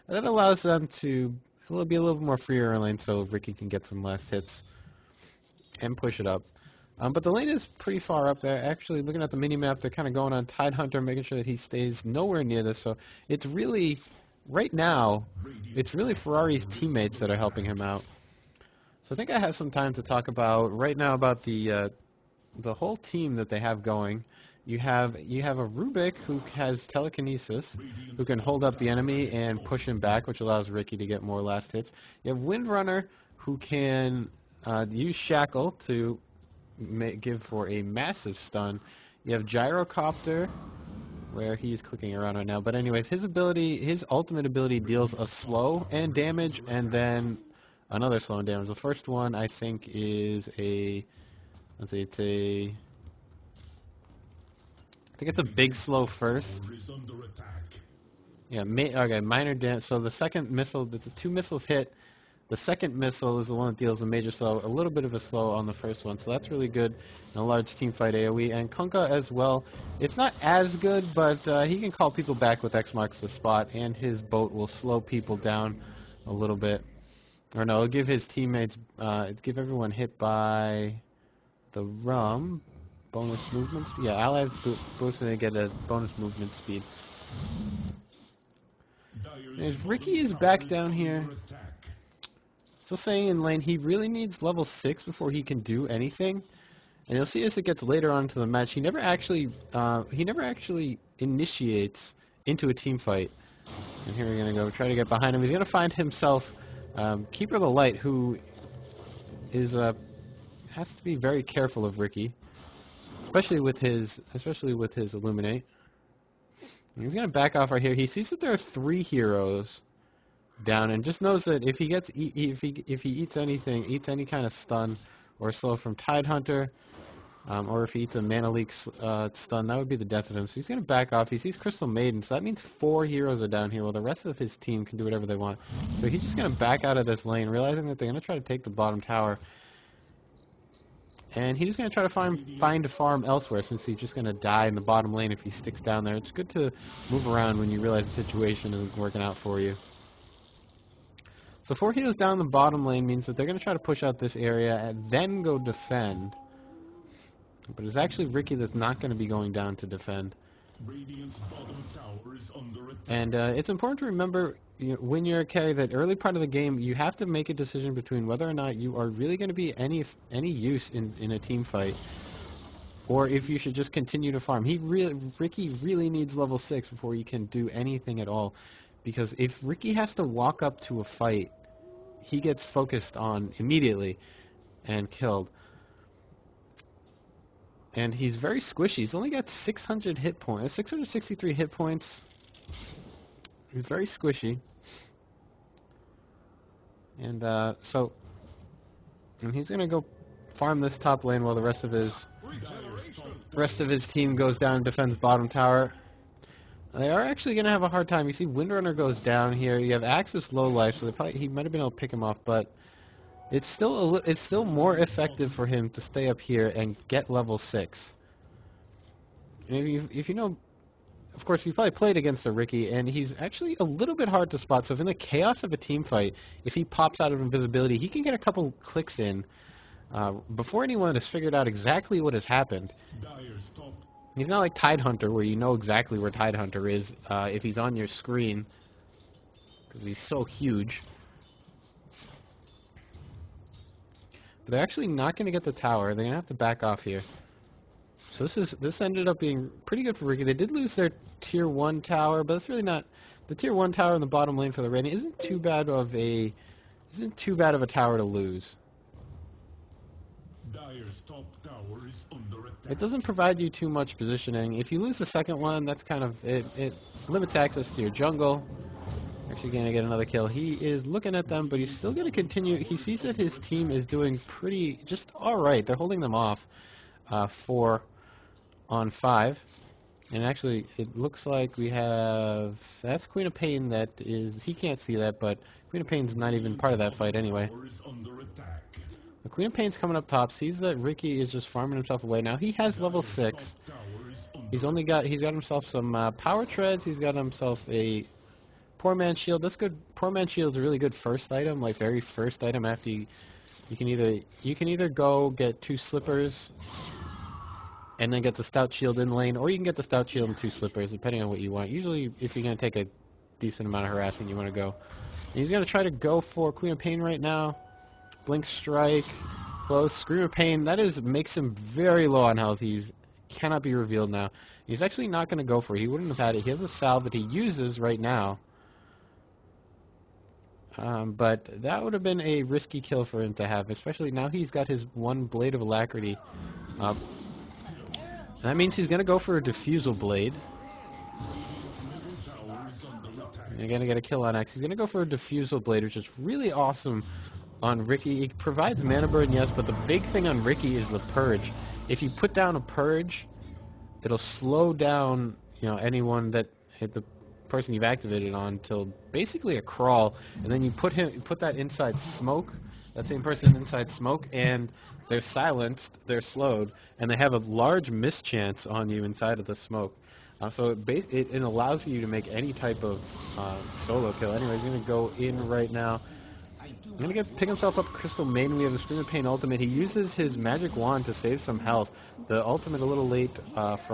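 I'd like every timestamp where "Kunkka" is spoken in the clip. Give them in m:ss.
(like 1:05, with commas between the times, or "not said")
1:08.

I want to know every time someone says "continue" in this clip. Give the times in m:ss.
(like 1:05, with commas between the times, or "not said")
2:53, 4:32.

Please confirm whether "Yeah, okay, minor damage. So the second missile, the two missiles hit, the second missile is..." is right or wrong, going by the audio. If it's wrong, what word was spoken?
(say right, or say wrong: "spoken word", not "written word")
right.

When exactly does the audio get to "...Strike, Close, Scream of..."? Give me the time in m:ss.
5:18.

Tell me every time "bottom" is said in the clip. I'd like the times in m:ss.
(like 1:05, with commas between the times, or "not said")
2:18, 2:24, 2:32, 3:25, 4:14.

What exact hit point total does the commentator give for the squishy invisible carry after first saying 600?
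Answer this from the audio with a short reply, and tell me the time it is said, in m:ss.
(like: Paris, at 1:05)
663, at 3:10.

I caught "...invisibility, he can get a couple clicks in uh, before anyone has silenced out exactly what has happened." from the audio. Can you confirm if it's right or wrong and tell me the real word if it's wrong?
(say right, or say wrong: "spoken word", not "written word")
wrong: "figured", not "silenced".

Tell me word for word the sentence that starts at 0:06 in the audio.
Um, but the lane is pretty far up there.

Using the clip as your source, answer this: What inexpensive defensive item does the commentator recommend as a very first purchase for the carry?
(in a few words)
Poor man's shield.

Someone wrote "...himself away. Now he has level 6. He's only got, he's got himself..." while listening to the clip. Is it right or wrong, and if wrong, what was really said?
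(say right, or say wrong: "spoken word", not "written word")
right.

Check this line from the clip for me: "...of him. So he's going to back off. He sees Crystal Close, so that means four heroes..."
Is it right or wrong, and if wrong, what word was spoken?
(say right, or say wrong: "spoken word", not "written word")
wrong: "Maiden", not "Close".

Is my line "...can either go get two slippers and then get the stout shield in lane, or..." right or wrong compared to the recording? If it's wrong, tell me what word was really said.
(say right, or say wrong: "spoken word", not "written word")
right.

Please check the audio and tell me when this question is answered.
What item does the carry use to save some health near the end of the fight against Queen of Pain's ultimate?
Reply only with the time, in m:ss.
6:20.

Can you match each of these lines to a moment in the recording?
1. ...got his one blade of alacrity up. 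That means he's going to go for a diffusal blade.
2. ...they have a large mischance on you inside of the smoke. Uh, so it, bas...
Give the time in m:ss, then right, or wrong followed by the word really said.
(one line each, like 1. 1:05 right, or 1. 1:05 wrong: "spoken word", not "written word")
1. 5:34 right
2. 6:07 right.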